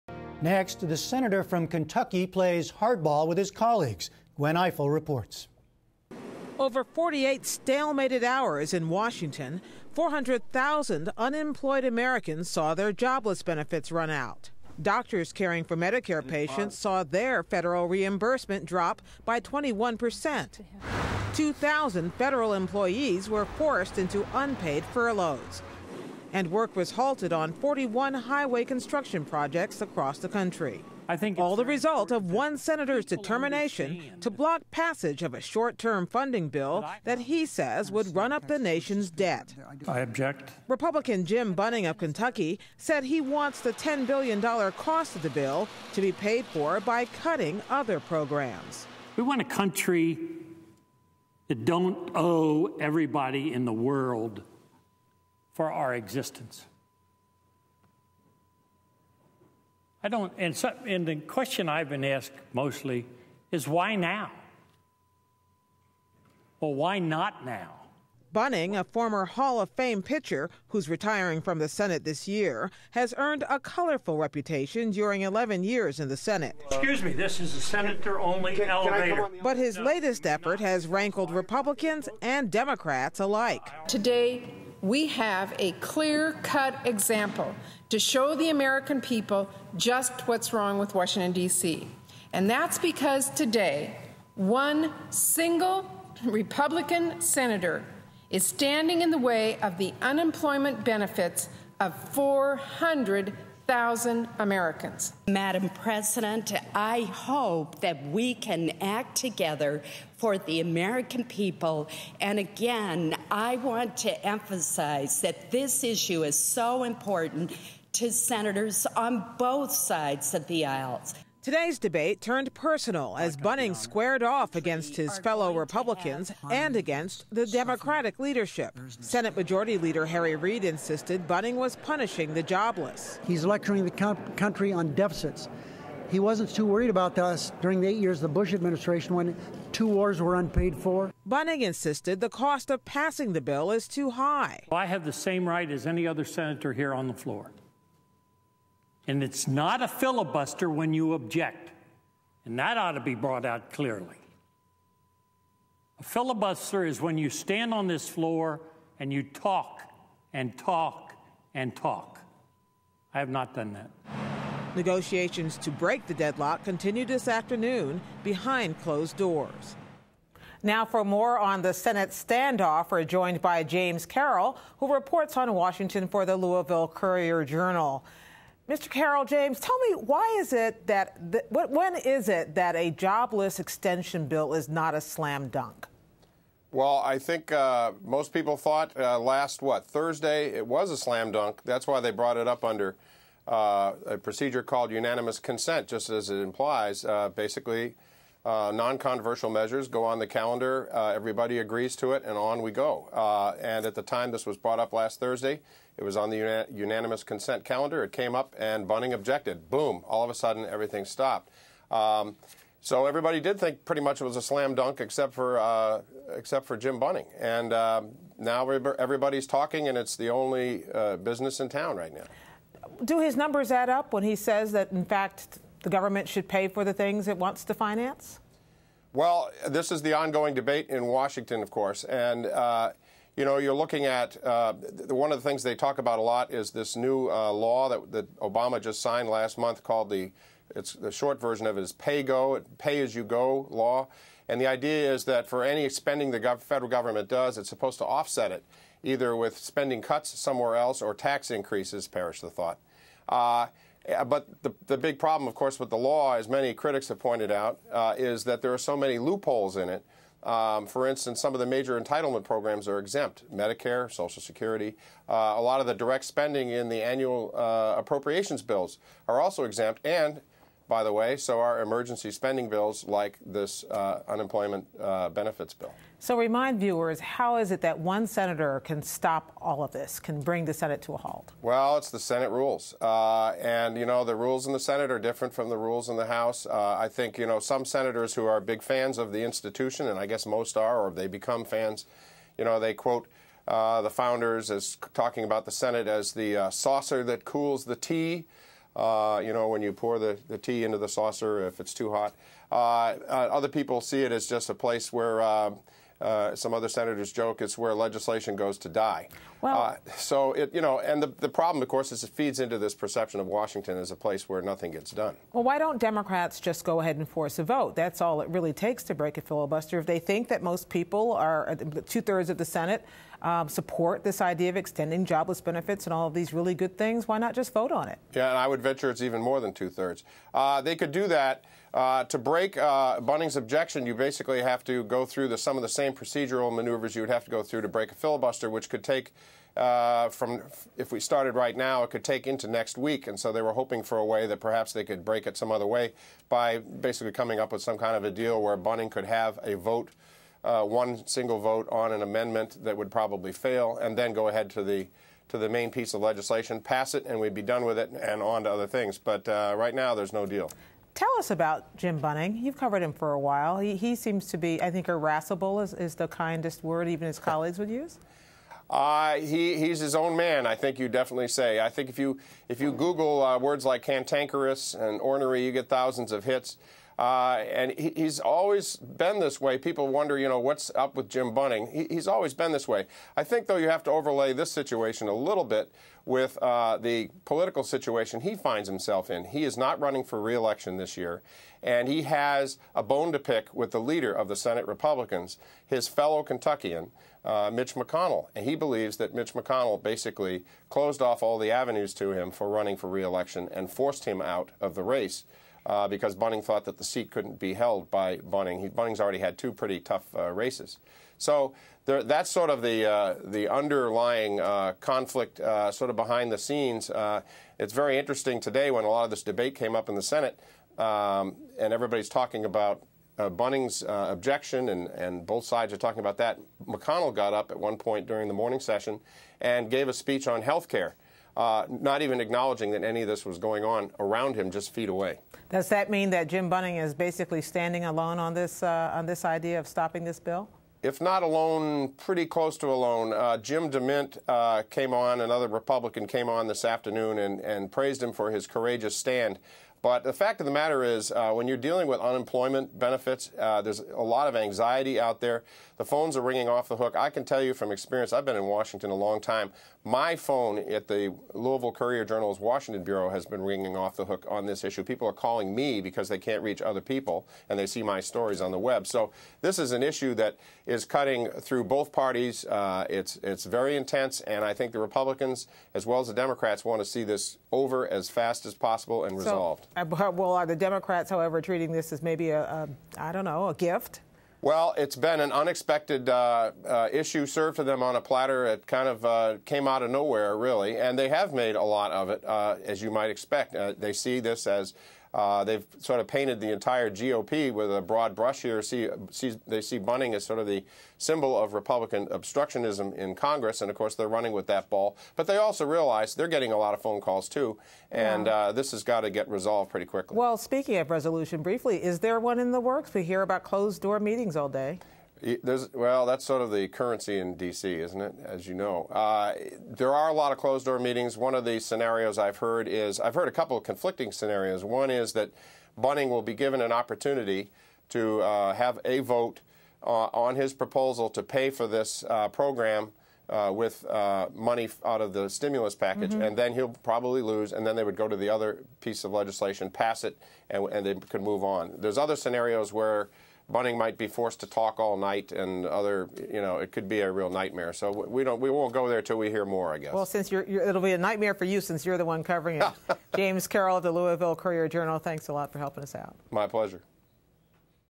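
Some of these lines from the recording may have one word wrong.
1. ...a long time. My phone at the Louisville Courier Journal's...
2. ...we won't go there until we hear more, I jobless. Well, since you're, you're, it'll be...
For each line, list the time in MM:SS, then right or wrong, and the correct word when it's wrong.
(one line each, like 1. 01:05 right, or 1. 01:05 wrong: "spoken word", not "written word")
1. 07:39 right
2. 09:08 wrong: "guess", not "jobless".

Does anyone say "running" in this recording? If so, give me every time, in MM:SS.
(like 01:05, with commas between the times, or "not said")
06:29, 06:42, 08:24.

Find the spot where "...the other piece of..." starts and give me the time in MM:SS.
08:58.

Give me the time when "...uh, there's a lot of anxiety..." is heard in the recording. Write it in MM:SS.
07:33.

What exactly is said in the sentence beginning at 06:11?
I think if you, if you Google uh, words like cantankerous and ornery, you get thousands of hits.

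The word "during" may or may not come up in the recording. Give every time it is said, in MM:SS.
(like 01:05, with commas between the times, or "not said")
01:14, 02:17, 07:08.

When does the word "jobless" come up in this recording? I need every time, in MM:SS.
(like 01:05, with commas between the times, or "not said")
00:12, 02:12, 03:02, 05:25.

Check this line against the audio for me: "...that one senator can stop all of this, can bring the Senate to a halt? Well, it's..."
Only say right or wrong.
right.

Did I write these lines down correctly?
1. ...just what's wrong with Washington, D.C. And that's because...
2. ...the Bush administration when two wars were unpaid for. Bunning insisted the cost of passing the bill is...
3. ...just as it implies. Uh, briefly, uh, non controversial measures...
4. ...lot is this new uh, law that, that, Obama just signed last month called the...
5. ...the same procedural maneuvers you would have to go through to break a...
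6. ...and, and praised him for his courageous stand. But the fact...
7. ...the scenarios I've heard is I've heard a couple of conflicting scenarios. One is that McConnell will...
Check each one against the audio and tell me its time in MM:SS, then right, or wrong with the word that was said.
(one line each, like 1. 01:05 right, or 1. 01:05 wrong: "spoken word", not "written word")
1. 01:29 right
2. 02:18 right
3. 03:15 wrong: "basically", not "briefly"
4. 03:56 right
5. 05:35 right
6. 07:27 right
7. 08:41 wrong: "Bunning", not "McConnell".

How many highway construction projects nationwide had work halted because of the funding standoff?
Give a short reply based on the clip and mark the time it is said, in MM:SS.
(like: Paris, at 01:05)
41, at 00:27.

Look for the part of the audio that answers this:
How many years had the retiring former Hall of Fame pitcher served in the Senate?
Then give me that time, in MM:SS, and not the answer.
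01:15.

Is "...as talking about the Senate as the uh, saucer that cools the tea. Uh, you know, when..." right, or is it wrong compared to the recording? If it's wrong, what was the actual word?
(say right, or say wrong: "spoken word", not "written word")
right.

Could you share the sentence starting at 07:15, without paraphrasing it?
Does that mean that Jim Bunning is basically standing alone on this uh, on this idea of stopping this bill?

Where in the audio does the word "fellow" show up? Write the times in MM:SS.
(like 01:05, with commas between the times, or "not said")
02:05, 06:36.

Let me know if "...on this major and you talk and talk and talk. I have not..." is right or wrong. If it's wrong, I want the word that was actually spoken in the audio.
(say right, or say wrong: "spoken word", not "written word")
wrong: "floor", not "major".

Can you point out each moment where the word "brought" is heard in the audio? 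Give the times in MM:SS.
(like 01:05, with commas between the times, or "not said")
02:33, 03:12, 03:24.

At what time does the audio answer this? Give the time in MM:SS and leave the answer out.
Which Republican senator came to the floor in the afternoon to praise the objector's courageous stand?
07:23.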